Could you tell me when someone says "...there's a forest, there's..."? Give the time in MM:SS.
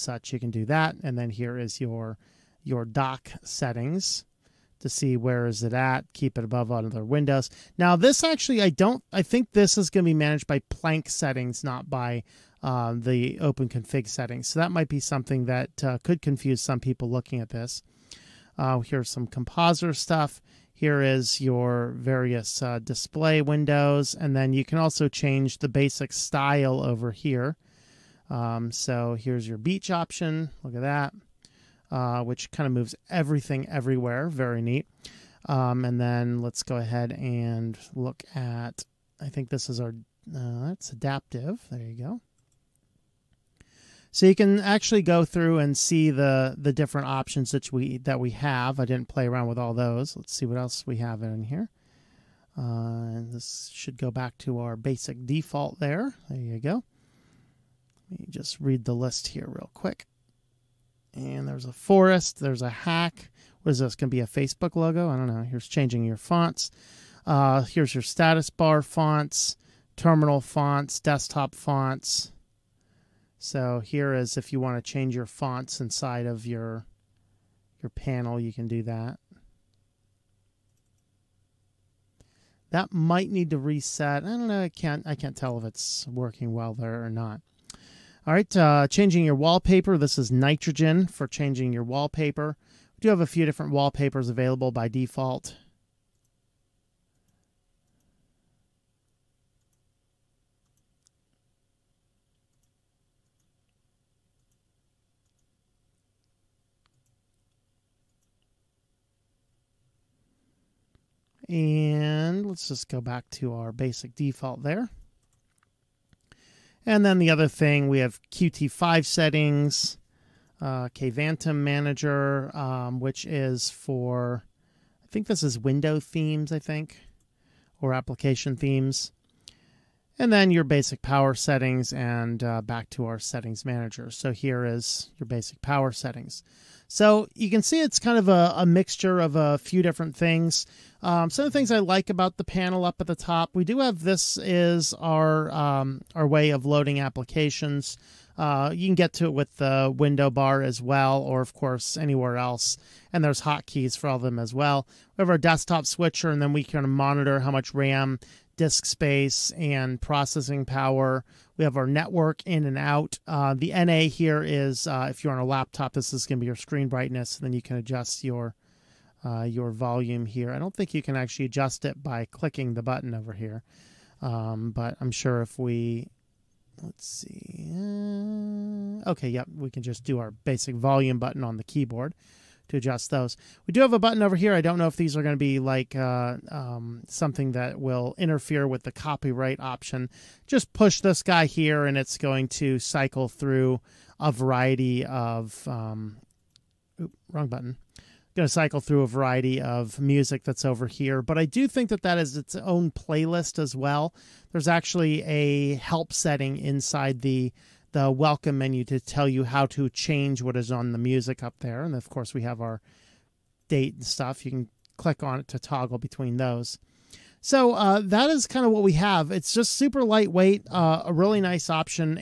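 01:01.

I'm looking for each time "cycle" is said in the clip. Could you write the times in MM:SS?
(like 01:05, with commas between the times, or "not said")
03:12, 03:18.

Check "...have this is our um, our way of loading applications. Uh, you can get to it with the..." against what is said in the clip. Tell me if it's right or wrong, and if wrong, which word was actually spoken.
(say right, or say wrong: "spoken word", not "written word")
right.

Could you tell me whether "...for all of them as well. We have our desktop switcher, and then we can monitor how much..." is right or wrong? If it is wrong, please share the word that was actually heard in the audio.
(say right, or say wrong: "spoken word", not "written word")
right.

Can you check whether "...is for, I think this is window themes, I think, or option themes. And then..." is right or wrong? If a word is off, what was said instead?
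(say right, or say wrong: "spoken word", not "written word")
wrong: "application", not "option".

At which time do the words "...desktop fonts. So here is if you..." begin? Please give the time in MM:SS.
01:10.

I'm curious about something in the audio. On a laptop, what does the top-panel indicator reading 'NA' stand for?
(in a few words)
screen brightness.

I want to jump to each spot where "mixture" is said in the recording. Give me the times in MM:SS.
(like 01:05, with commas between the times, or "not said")
02:18.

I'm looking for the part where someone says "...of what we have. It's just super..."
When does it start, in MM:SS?
03:38.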